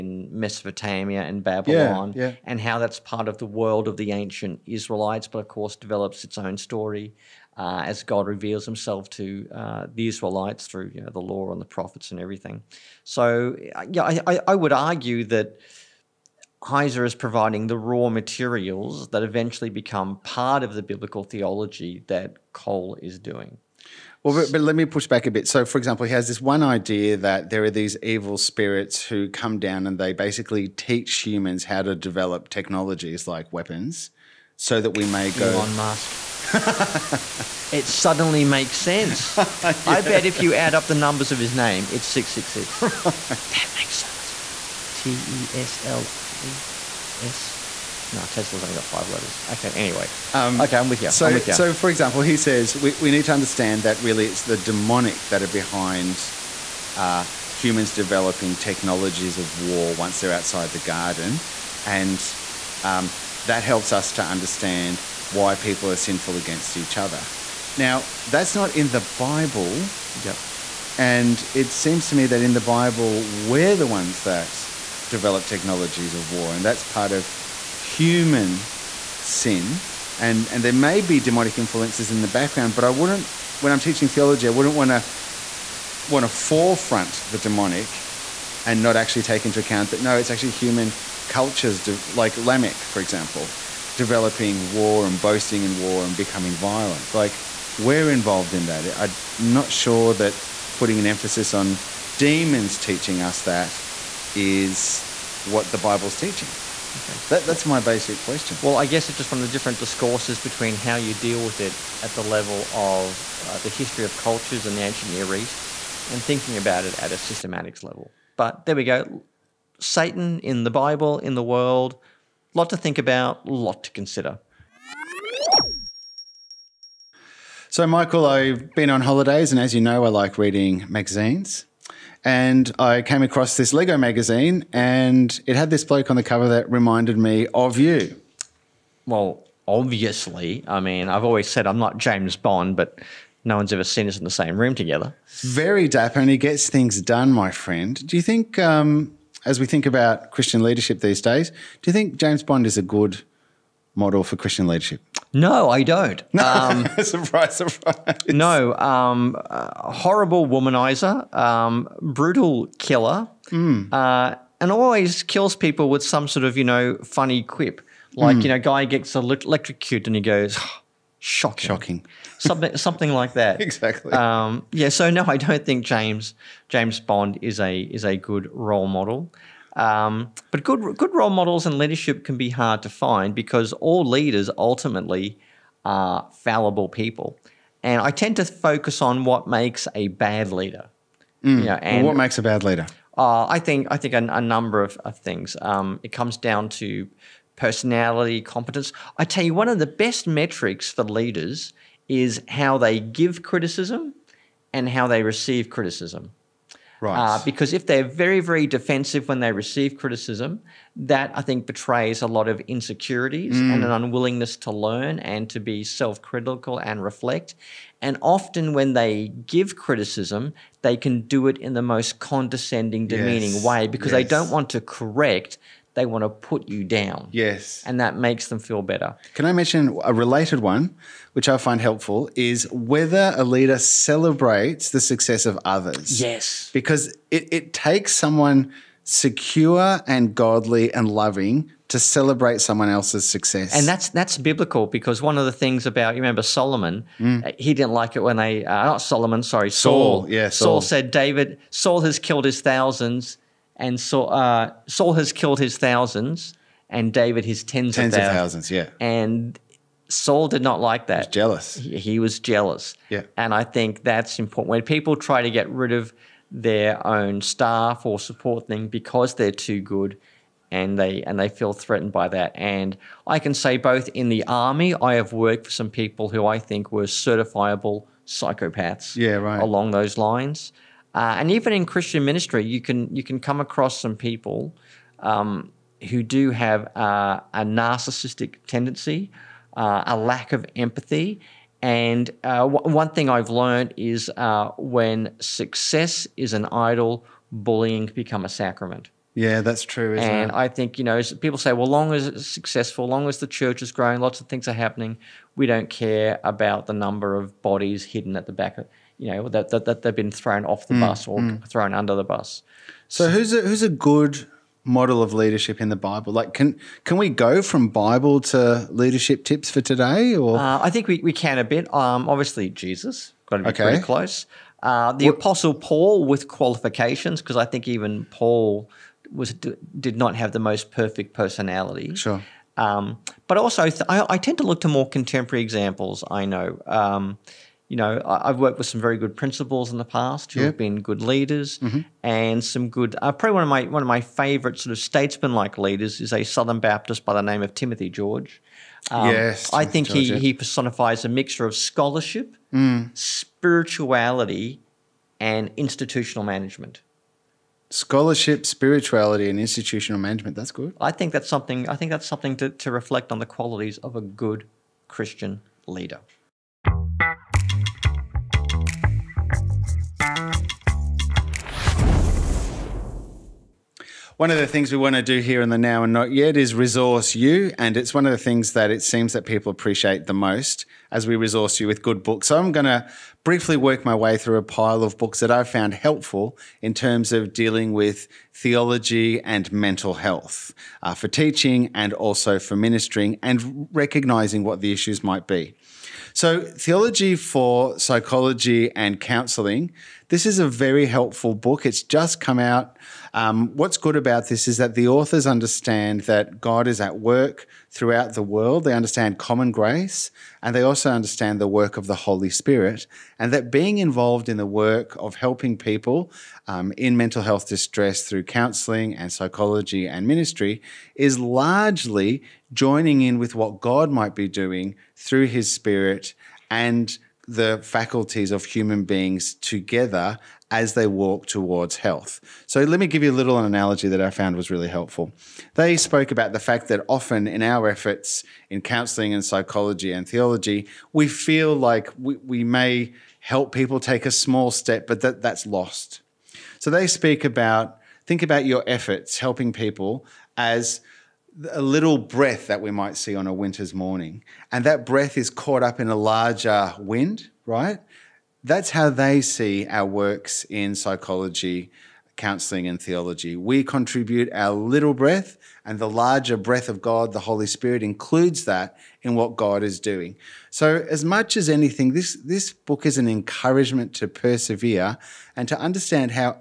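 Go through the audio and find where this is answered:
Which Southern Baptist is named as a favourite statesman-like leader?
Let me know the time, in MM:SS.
05:47.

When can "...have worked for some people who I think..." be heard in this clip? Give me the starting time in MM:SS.
04:35.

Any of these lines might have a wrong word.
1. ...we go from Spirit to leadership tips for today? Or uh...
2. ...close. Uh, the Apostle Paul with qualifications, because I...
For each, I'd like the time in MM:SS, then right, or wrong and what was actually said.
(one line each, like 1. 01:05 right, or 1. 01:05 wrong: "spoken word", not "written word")
1. 05:17 wrong: "Bible", not "Spirit"
2. 05:24 right.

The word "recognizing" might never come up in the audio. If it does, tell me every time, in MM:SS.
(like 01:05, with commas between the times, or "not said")
06:33.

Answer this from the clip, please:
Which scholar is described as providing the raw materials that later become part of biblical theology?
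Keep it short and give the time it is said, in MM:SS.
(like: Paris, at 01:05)
Heiser, at 00:16.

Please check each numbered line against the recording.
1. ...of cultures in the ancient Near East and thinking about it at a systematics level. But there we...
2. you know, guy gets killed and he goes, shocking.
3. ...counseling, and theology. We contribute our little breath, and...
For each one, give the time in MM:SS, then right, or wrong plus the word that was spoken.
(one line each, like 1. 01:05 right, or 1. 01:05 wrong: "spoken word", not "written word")
1. 01:54 right
2. 02:48 wrong: "electrocuted", not "killed"
3. 07:42 right.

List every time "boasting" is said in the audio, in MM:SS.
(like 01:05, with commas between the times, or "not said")
01:35.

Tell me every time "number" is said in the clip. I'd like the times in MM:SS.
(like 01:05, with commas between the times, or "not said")
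00:40, 03:14, 05:06.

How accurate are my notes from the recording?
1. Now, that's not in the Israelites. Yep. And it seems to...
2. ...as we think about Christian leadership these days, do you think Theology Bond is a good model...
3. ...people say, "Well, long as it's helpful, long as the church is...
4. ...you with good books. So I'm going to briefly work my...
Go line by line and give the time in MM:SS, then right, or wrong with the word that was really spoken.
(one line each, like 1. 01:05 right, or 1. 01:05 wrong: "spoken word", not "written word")
1. 01:07 wrong: "Bible", not "Israelites"
2. 02:29 wrong: "James", not "Theology"
3. 05:01 wrong: "successful", not "helpful"
4. 06:21 right.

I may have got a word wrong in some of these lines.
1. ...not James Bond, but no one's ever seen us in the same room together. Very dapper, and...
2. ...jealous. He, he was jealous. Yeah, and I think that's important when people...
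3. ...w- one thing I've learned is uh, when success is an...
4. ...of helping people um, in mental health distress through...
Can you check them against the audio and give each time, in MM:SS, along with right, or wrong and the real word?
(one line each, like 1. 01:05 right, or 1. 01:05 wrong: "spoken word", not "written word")
1. 02:21 right
2. 04:21 right
3. 04:52 right
4. 06:55 right.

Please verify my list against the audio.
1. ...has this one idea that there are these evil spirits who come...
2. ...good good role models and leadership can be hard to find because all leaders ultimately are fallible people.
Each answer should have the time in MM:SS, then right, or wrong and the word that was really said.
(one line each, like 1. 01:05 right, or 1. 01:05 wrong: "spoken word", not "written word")
1. 00:26 right
2. 03:00 right.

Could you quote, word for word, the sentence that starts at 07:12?
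So, let me give you a little analogy that I found was really helpful.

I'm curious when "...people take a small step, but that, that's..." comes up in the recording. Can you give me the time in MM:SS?
07:23.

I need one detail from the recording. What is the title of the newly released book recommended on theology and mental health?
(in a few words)
Theology for Psychology and Counseling.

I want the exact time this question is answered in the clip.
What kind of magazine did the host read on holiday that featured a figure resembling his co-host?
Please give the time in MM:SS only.
02:13.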